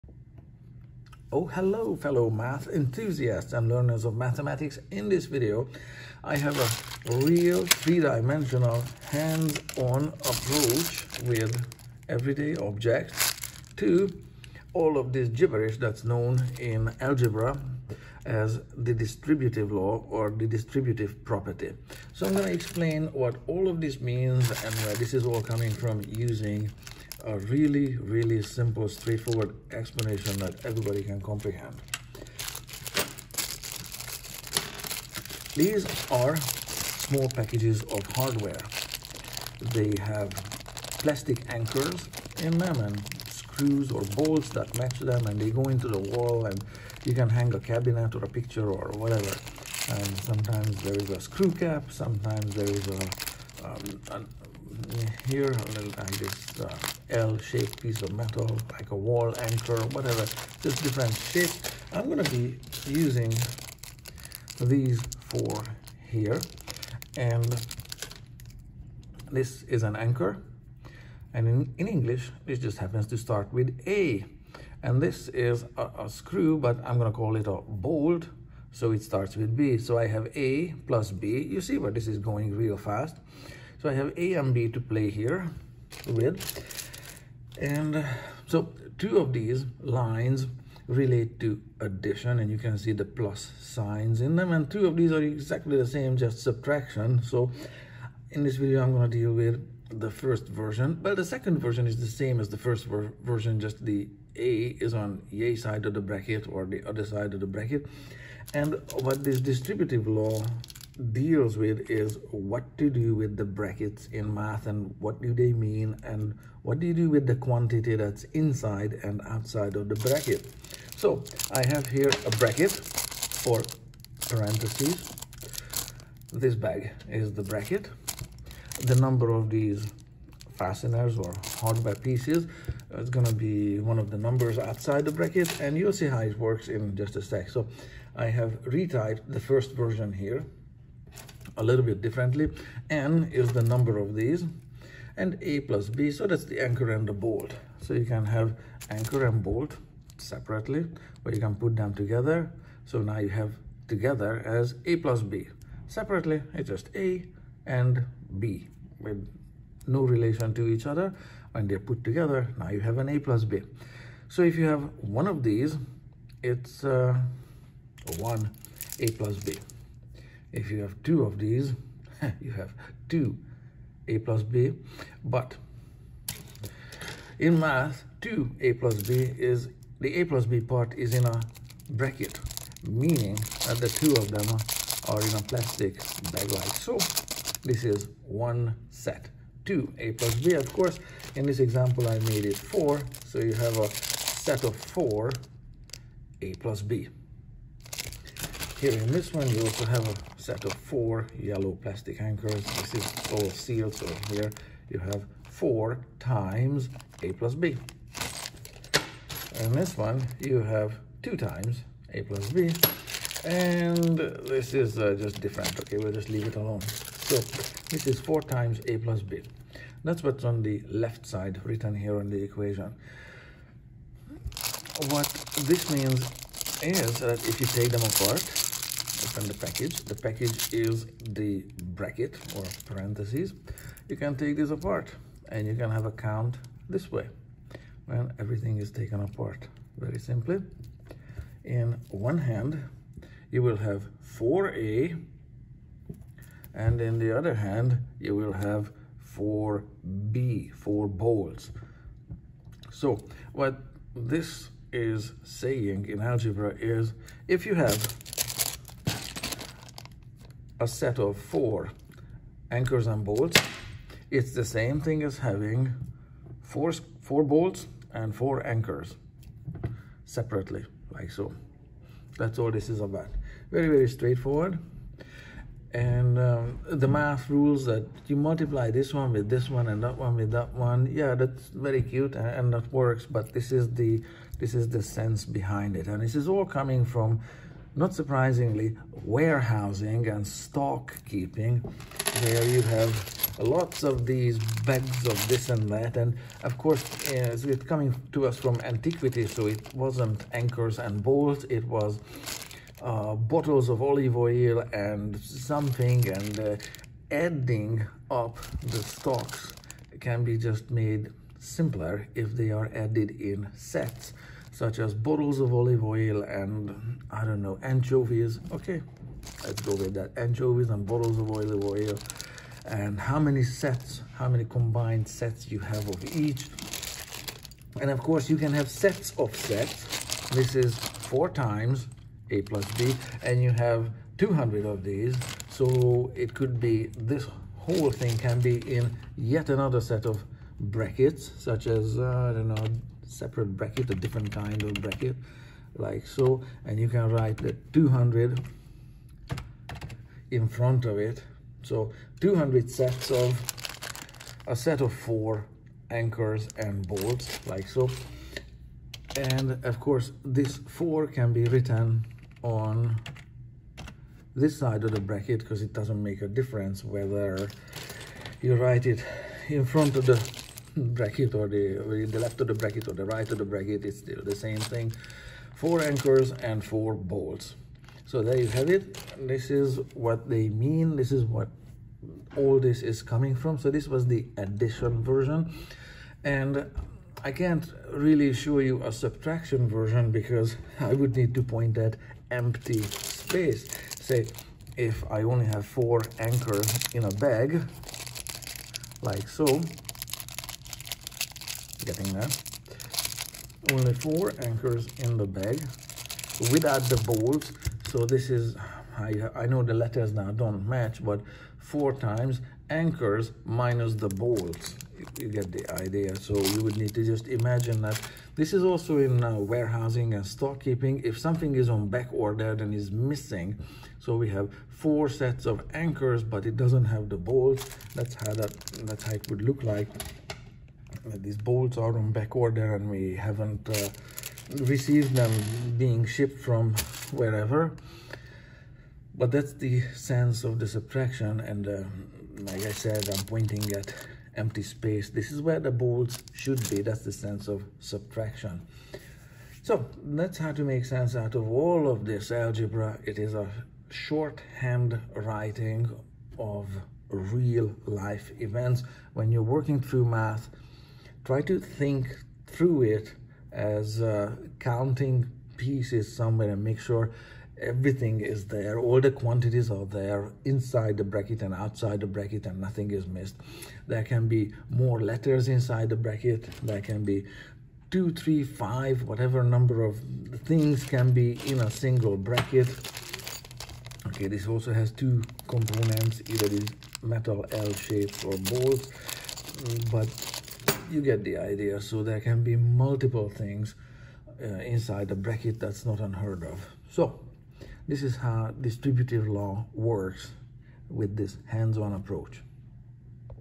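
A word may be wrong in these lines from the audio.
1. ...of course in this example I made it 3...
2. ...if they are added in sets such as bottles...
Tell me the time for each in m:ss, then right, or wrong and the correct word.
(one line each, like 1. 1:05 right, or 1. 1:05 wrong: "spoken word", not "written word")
1. 3:10 wrong: "4", not "3"
2. 5:12 right.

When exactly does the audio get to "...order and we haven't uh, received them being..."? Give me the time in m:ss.
7:12.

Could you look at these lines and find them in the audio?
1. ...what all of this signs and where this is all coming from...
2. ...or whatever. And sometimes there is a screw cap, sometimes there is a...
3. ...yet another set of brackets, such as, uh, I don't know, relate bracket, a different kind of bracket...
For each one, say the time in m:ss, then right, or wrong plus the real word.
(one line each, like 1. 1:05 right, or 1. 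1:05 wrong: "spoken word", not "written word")
1. 0:23 wrong: "means", not "signs"
2. 0:48 right
3. 5:39 wrong: "separate", not "relate".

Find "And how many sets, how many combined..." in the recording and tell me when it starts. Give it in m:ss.
5:22.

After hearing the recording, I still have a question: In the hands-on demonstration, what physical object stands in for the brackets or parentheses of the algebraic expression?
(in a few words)
plastic bag.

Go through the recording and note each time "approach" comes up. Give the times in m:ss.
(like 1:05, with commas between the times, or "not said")
0:10, 8:22.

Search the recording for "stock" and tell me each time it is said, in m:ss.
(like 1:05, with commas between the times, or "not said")
4:50, 5:09, 7:00.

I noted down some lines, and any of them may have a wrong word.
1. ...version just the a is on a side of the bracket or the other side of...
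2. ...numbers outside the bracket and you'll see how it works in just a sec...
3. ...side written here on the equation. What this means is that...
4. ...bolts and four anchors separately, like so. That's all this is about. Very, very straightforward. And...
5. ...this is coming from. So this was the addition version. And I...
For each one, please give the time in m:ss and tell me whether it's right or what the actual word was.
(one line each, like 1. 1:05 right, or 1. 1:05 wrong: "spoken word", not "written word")
1. 1:43 right
2. 2:14 right
3. 3:41 right
4. 4:27 right
5. 6:22 right.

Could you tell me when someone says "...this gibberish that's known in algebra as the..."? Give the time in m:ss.
0:15.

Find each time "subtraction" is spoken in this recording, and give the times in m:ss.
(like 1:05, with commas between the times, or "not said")
1:36, 6:29, 7:20, 7:27.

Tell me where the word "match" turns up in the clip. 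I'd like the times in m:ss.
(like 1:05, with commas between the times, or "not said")
0:44, 6:50.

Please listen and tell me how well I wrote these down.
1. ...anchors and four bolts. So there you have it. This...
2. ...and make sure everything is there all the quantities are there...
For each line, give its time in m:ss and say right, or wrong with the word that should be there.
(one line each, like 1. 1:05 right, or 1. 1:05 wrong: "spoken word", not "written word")
1. 6:16 right
2. 7:46 right.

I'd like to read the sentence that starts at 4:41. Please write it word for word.
Yeah, that's very cute and, and that works, but this is the this is the sense behind it.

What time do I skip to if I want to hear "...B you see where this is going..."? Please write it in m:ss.
1:21.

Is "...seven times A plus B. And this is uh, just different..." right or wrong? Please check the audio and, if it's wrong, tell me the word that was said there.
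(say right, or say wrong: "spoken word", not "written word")
wrong: "two", not "seven".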